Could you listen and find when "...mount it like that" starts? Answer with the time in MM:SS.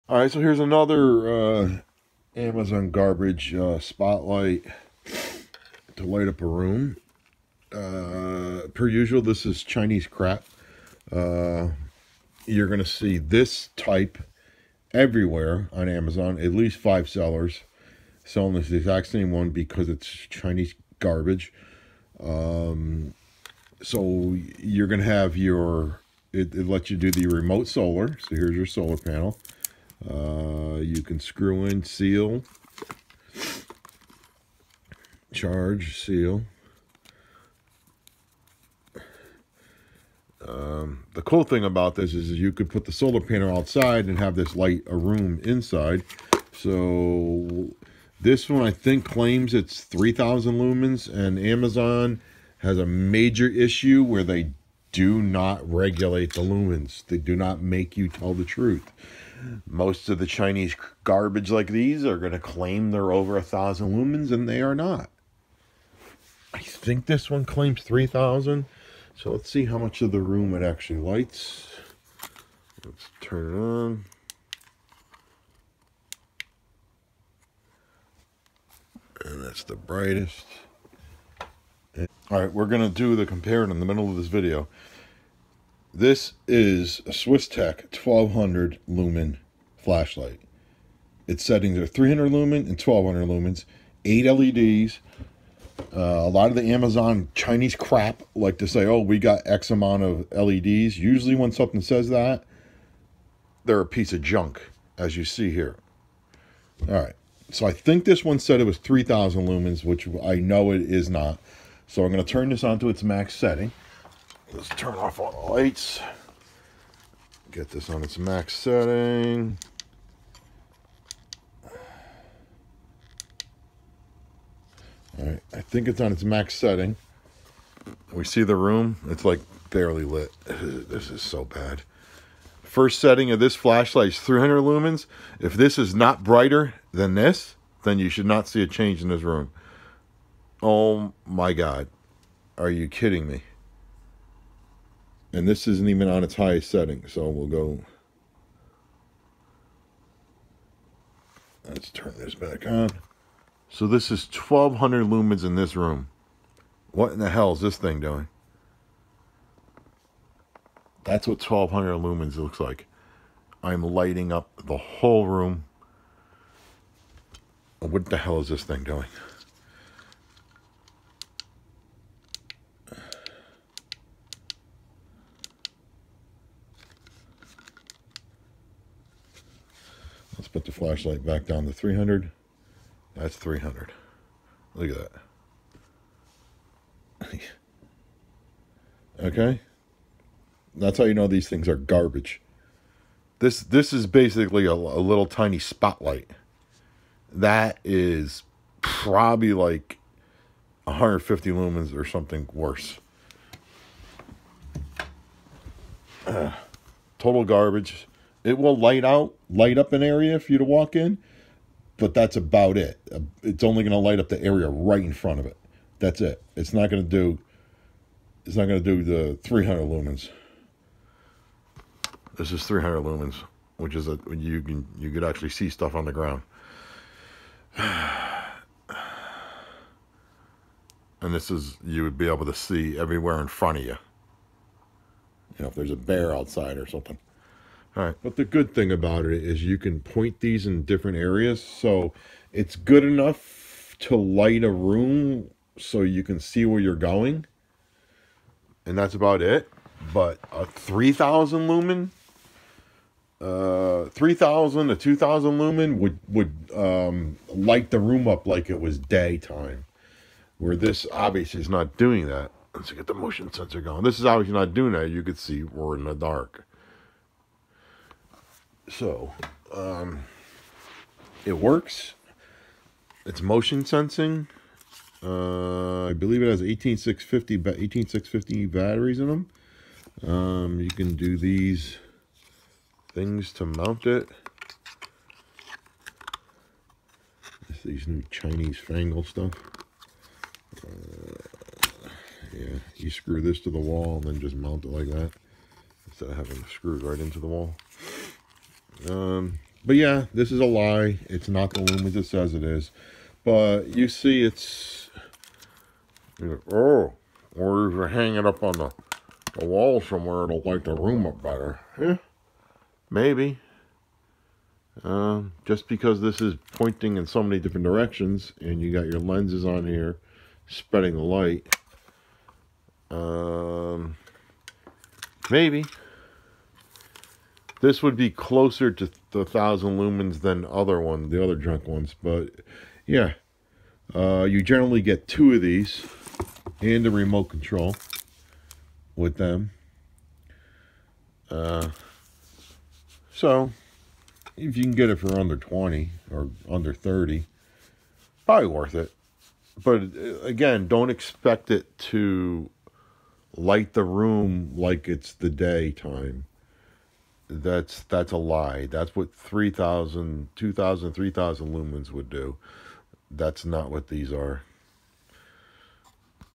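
04:54.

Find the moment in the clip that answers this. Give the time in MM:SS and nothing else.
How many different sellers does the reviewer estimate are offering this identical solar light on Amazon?
00:16.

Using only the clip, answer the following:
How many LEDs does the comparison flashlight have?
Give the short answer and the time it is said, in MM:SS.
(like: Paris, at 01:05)
8, at 01:34.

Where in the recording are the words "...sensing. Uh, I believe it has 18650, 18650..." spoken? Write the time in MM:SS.
04:33.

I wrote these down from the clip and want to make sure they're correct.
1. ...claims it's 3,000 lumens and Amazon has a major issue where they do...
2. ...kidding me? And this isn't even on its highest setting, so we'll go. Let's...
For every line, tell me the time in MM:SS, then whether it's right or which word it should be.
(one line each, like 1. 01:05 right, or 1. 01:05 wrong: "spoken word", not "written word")
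1. 00:49 right
2. 02:22 right.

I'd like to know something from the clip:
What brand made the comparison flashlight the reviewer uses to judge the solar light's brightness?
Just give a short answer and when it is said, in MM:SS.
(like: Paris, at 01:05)
Swiss Tech, at 01:27.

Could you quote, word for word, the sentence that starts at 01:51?
So I'm going to turn this on to its max setting.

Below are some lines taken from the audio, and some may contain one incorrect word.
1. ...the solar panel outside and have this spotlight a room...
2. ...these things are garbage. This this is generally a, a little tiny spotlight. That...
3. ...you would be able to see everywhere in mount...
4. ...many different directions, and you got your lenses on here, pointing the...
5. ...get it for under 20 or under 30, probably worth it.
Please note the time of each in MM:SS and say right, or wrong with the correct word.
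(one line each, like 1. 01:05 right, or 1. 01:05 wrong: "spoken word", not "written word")
1. 00:42 wrong: "light", not "spotlight"
2. 03:11 wrong: "basically", not "generally"
3. 03:51 wrong: "front", not "mount"
4. 05:17 wrong: "spreading", not "pointing"
5. 05:44 right.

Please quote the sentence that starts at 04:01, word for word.
So it's good enough to light a room so you can see where you're going.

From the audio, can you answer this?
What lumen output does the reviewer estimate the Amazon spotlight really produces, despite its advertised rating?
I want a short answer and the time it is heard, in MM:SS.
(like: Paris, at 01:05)
150, at 03:20.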